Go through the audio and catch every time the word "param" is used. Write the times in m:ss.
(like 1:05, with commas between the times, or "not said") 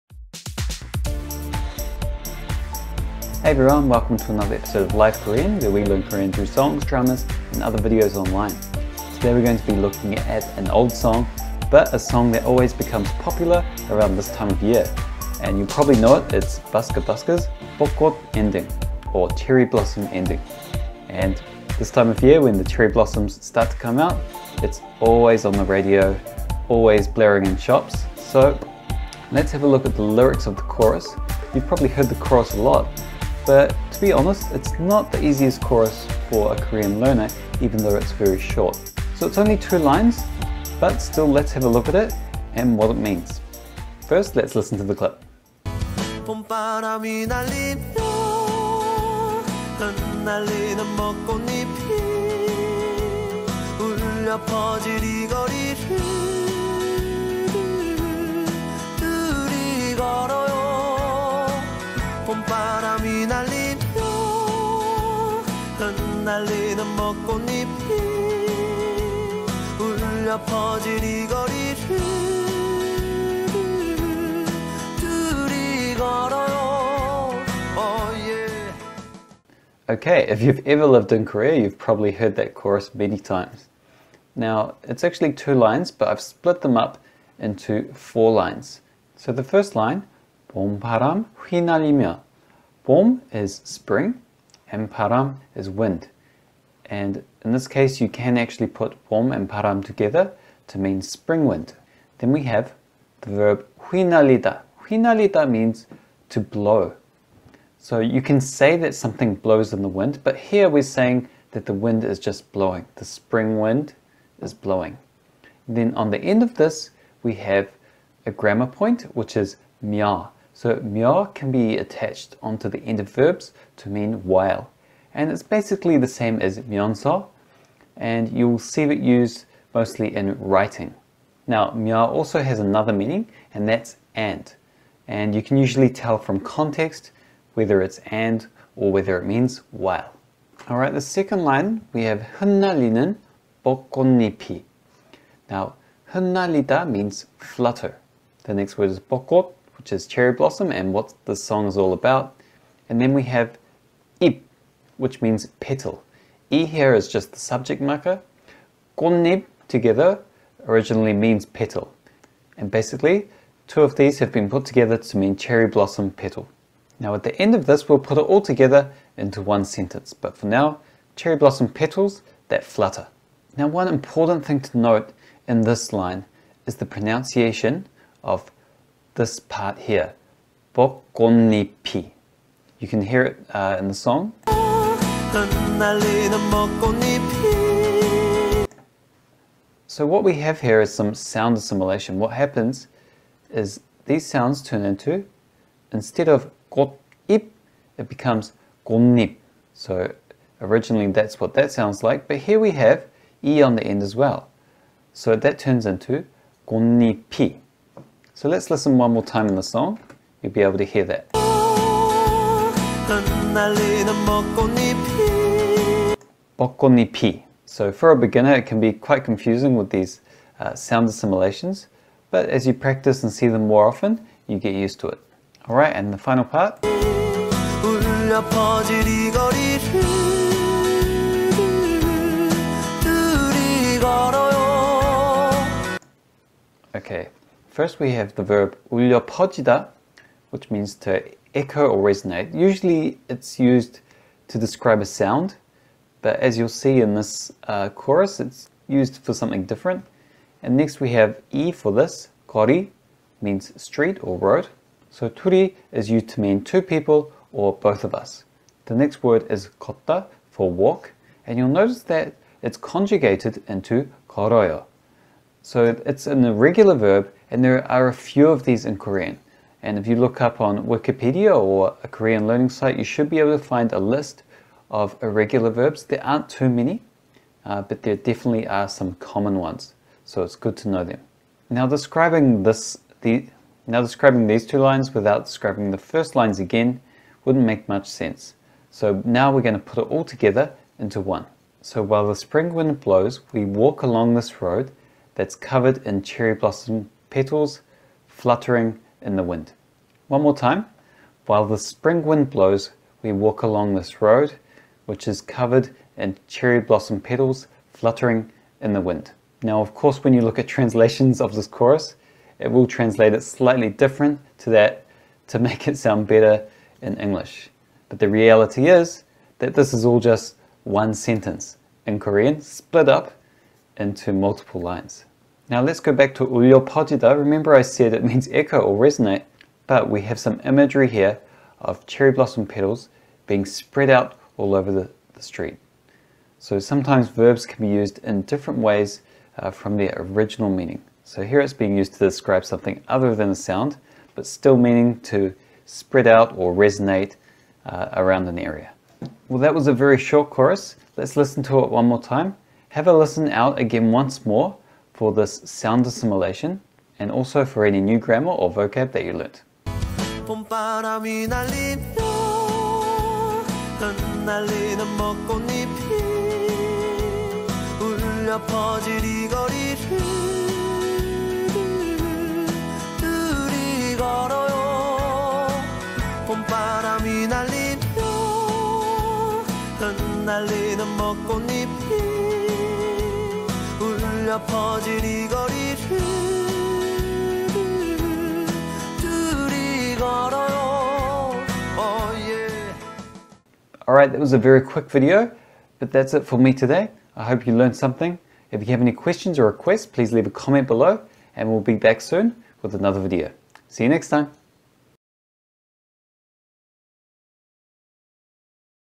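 1:34, 1:39.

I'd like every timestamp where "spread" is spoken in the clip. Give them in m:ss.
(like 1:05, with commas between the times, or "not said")
5:33, 5:45.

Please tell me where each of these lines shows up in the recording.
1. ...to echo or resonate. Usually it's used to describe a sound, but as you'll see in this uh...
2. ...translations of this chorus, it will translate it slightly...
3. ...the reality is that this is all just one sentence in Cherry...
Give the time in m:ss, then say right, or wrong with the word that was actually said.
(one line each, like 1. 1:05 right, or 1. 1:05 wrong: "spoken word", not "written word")
1. 4:00 right
2. 5:10 right
3. 5:18 wrong: "Korean", not "Cherry".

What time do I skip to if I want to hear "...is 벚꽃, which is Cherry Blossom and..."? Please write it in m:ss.
2:28.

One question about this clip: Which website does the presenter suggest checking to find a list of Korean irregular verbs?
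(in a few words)
Wikipedia.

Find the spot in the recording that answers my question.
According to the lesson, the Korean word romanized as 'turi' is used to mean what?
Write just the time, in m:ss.
4:16.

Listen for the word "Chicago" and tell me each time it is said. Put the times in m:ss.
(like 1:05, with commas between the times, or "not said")
not said.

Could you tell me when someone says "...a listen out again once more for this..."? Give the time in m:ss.
5:53.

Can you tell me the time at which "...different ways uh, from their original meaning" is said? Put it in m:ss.
5:38.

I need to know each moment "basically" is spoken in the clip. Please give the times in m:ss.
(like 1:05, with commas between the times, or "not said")
2:05, 2:42.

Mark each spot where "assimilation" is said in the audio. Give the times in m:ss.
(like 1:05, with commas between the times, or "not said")
3:11, 3:41, 5:56.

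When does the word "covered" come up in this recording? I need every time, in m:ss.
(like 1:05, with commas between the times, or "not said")
4:55, 5:05.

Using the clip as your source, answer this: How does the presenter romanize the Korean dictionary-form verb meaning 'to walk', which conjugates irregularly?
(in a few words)
kotta.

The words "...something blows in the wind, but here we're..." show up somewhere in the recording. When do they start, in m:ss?
1:48.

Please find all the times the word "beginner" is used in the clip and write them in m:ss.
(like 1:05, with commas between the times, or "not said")
3:38.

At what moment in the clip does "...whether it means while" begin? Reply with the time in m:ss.
2:18.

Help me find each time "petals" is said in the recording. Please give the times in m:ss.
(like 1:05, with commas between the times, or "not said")
2:35, 2:41, 2:46, 2:51, 4:57, 5:07, 5:32.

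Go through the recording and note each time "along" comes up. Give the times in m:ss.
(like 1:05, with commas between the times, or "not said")
4:54, 5:03.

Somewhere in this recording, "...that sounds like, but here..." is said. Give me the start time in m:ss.
3:21.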